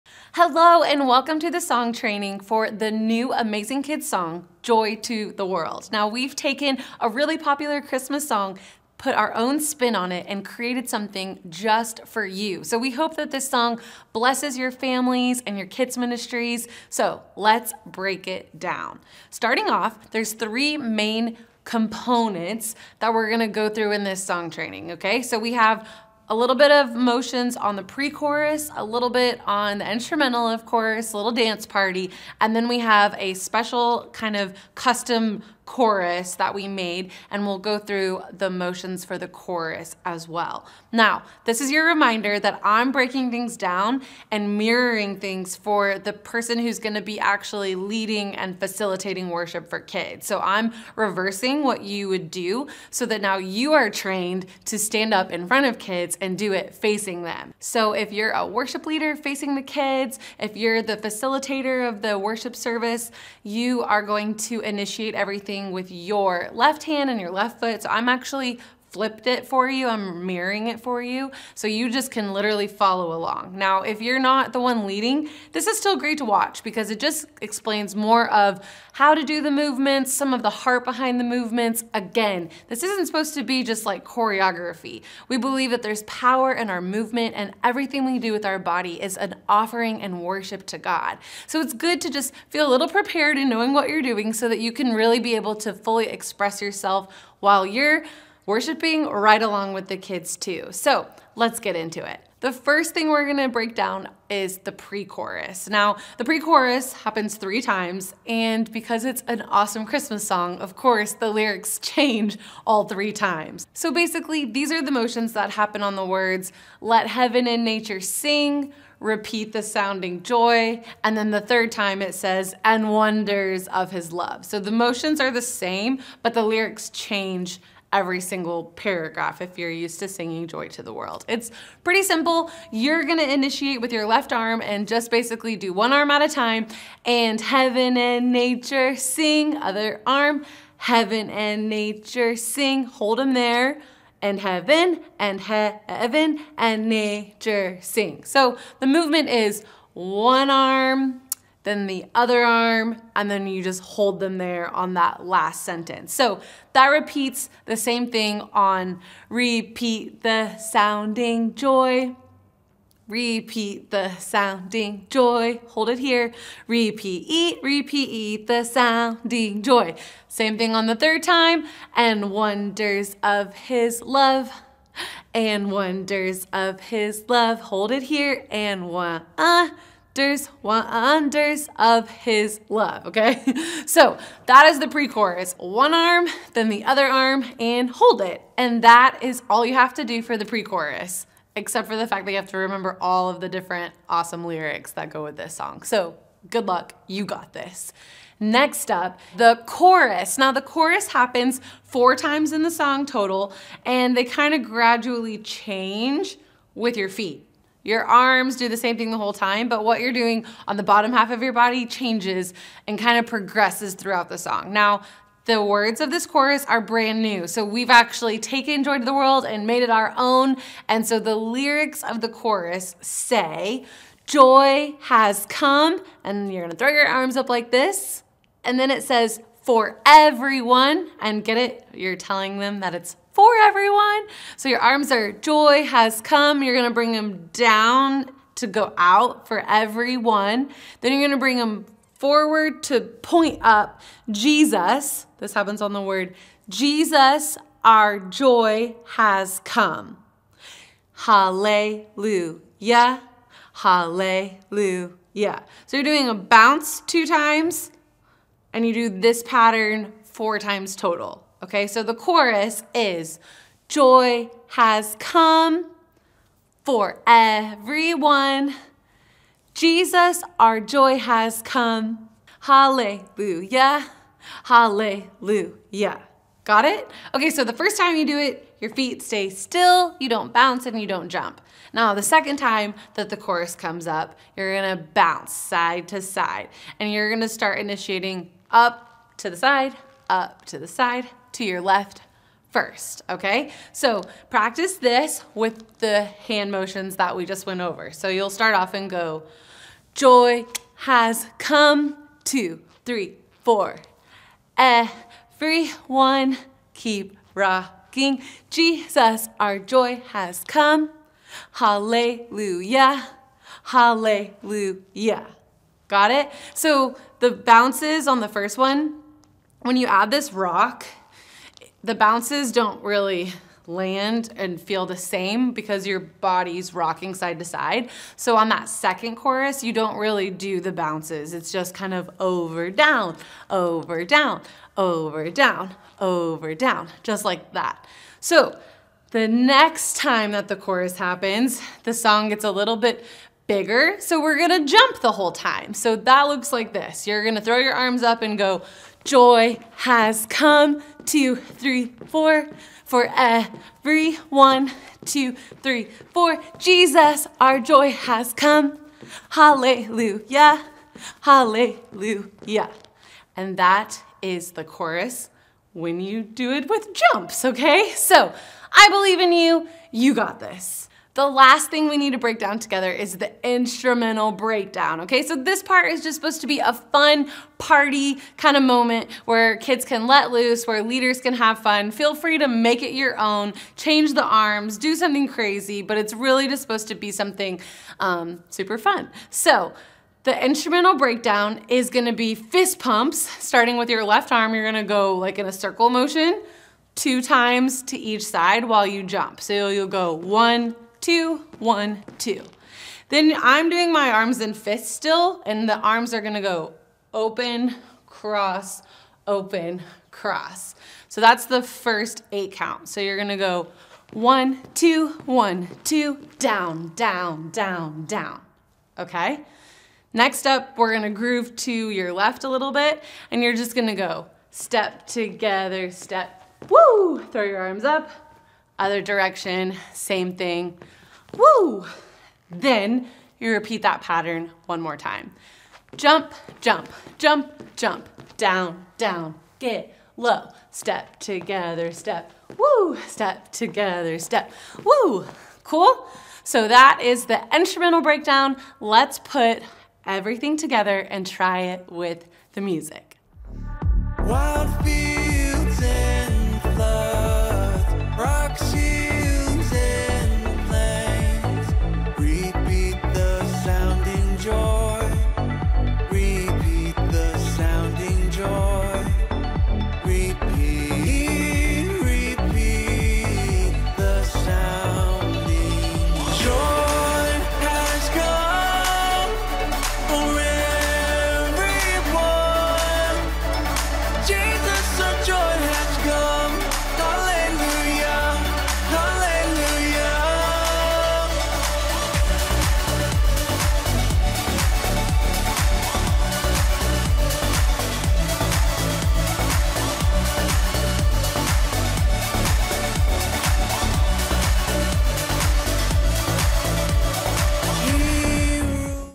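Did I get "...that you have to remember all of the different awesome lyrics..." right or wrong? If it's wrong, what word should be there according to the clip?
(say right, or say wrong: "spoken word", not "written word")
right.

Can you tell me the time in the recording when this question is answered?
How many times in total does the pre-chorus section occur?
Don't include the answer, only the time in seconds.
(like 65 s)
106 s.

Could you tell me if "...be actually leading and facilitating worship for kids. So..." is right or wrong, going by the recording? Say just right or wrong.
right.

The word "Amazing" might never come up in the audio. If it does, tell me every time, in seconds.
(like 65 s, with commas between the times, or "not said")
3 s.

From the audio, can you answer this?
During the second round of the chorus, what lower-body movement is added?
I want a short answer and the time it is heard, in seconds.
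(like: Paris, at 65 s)
Bounce side to side, at 285 s.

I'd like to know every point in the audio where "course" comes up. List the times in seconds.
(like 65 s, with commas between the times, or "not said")
30 s, 110 s.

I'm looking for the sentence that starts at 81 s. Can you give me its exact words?
Again, this isn't supposed to be just like choreography.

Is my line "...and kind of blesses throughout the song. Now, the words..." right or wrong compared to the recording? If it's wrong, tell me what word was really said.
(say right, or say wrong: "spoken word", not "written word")
wrong: "progresses", not "blesses".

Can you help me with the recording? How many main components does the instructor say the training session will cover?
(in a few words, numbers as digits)
3.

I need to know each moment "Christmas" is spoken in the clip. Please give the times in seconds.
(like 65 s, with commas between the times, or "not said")
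7 s, 109 s.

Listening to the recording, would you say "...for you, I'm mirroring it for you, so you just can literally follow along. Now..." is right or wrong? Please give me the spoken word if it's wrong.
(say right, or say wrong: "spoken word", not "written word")
right.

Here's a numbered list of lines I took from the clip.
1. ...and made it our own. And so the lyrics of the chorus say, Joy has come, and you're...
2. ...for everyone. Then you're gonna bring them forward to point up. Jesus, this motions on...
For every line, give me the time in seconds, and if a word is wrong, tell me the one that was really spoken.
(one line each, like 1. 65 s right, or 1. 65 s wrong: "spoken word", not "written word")
1. 219 s right
2. 239 s wrong: "happens", not "motions".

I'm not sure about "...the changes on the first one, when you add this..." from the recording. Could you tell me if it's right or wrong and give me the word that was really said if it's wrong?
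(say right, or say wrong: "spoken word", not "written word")
wrong: "bounces", not "changes".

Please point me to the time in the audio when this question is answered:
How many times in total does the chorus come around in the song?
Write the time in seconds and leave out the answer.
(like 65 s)
200 s.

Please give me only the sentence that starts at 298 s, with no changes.
So you'll start off and go, joy has come, two, three, four.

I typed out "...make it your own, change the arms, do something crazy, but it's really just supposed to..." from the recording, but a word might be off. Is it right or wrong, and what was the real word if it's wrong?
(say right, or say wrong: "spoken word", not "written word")
right.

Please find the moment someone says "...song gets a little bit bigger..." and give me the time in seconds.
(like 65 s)
342 s.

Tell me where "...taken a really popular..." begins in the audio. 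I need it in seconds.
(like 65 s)
6 s.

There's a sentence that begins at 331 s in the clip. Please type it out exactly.
It's just kind of over, down, over, down, over, down, over, down, just like that.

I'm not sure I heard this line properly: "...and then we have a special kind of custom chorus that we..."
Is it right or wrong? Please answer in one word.
right.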